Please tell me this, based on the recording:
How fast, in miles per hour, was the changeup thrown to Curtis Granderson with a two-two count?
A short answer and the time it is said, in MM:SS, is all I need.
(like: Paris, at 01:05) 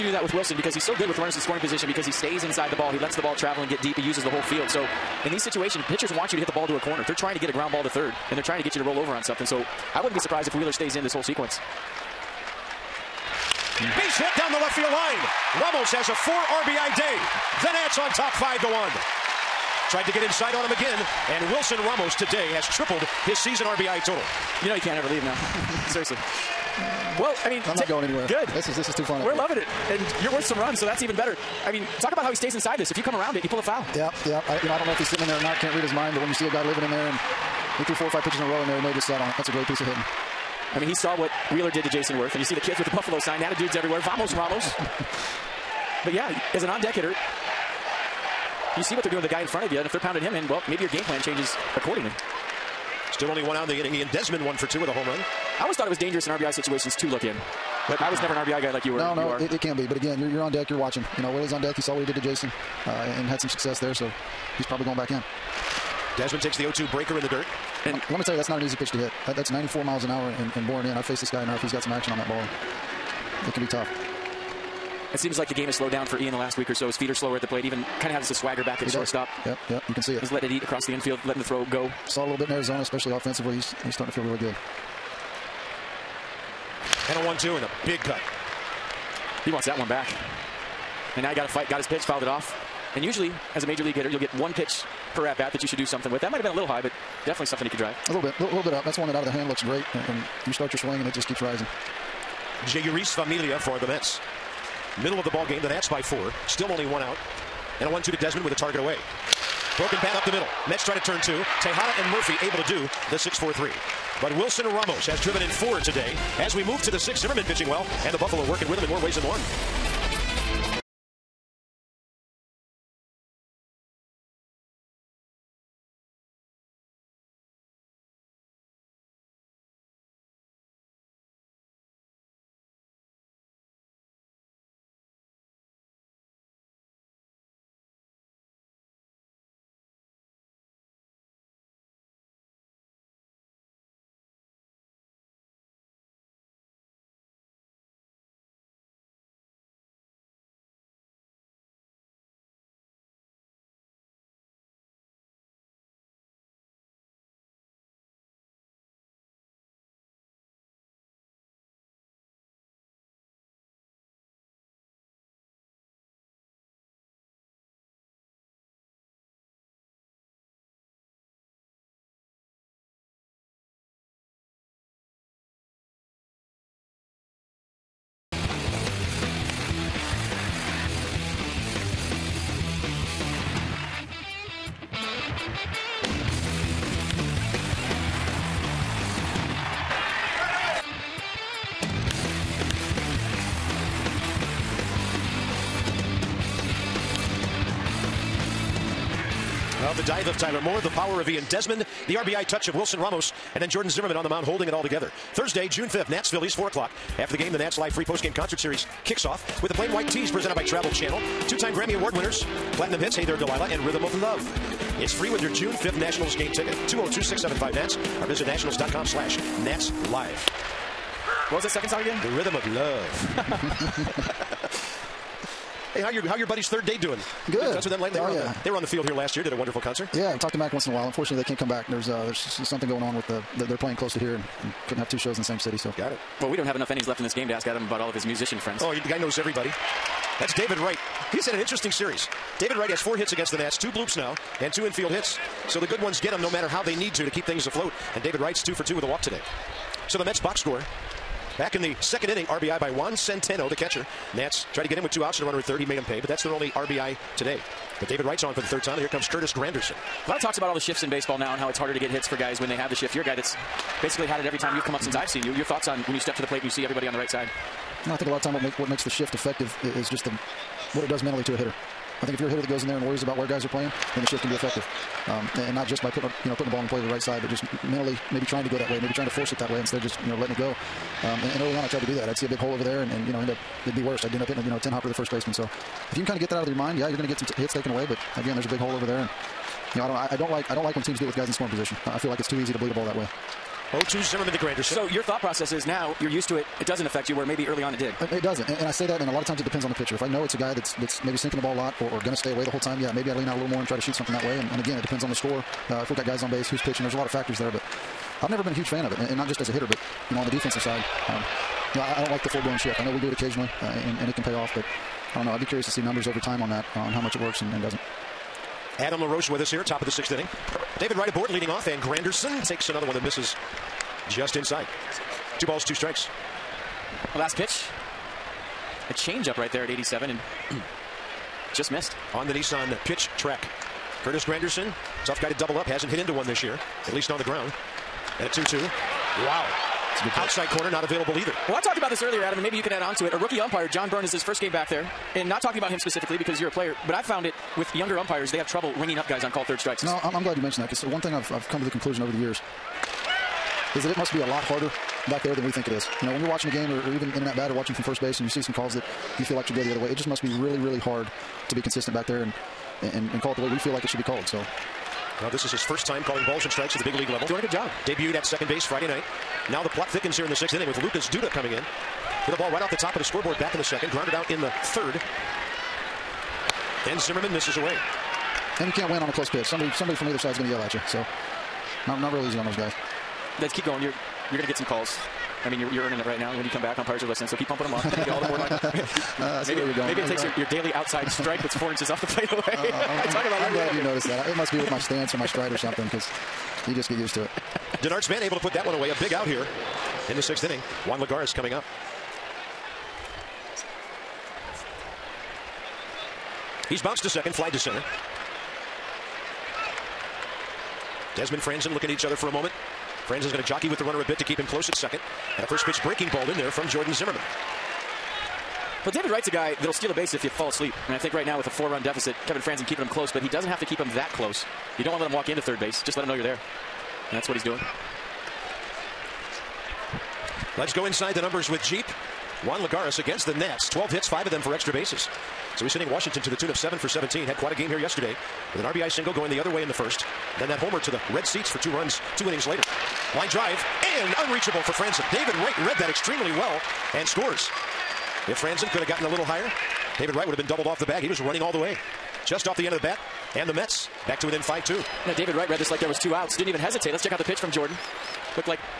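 87, at 05:29.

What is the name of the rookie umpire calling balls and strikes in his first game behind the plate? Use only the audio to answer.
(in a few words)
John Byrne.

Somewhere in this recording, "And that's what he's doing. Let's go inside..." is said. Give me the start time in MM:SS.
07:07.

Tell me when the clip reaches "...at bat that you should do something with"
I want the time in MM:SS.
01:35.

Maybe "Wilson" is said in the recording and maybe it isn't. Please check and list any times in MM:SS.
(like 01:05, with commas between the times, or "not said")
00:00, 00:21, 01:54, 03:22.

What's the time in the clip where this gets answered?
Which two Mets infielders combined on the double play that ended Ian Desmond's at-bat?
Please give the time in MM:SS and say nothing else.
01:51.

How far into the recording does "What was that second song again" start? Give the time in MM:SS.
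03:41.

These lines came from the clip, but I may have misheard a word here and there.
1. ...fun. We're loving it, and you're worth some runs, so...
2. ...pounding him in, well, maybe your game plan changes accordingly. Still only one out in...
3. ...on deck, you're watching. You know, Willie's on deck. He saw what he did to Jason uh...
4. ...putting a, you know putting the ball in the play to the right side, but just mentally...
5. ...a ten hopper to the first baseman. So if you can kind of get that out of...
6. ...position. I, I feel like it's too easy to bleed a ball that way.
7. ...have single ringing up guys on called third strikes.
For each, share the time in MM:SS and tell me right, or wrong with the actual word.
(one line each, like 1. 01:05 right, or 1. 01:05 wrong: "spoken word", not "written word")
1. 00:29 right
2. 00:49 right
3. 01:00 right
4. 04:36 right
5. 04:44 right
6. 04:51 right
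7. 05:48 wrong: "trouble", not "single".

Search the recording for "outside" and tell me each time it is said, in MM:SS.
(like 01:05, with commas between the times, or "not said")
05:40, 06:30.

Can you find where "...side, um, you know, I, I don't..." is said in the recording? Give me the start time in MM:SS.
05:10.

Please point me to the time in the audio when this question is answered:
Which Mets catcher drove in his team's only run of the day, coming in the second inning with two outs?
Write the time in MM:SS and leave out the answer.
04:12.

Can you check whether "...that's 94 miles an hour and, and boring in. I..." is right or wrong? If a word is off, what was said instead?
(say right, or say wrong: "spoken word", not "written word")
right.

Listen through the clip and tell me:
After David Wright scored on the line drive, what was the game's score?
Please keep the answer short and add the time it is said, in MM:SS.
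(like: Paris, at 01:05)
5-2, at 07:34.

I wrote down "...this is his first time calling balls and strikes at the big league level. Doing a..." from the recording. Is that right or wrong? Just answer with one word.
right.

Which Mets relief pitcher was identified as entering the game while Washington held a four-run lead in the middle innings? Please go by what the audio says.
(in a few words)
Jeurys Familia.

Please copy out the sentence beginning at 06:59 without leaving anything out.
Well, David Wright's a guy that'll steal a base if you fall asleep.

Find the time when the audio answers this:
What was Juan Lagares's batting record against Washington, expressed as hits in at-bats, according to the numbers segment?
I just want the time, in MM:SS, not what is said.
07:16.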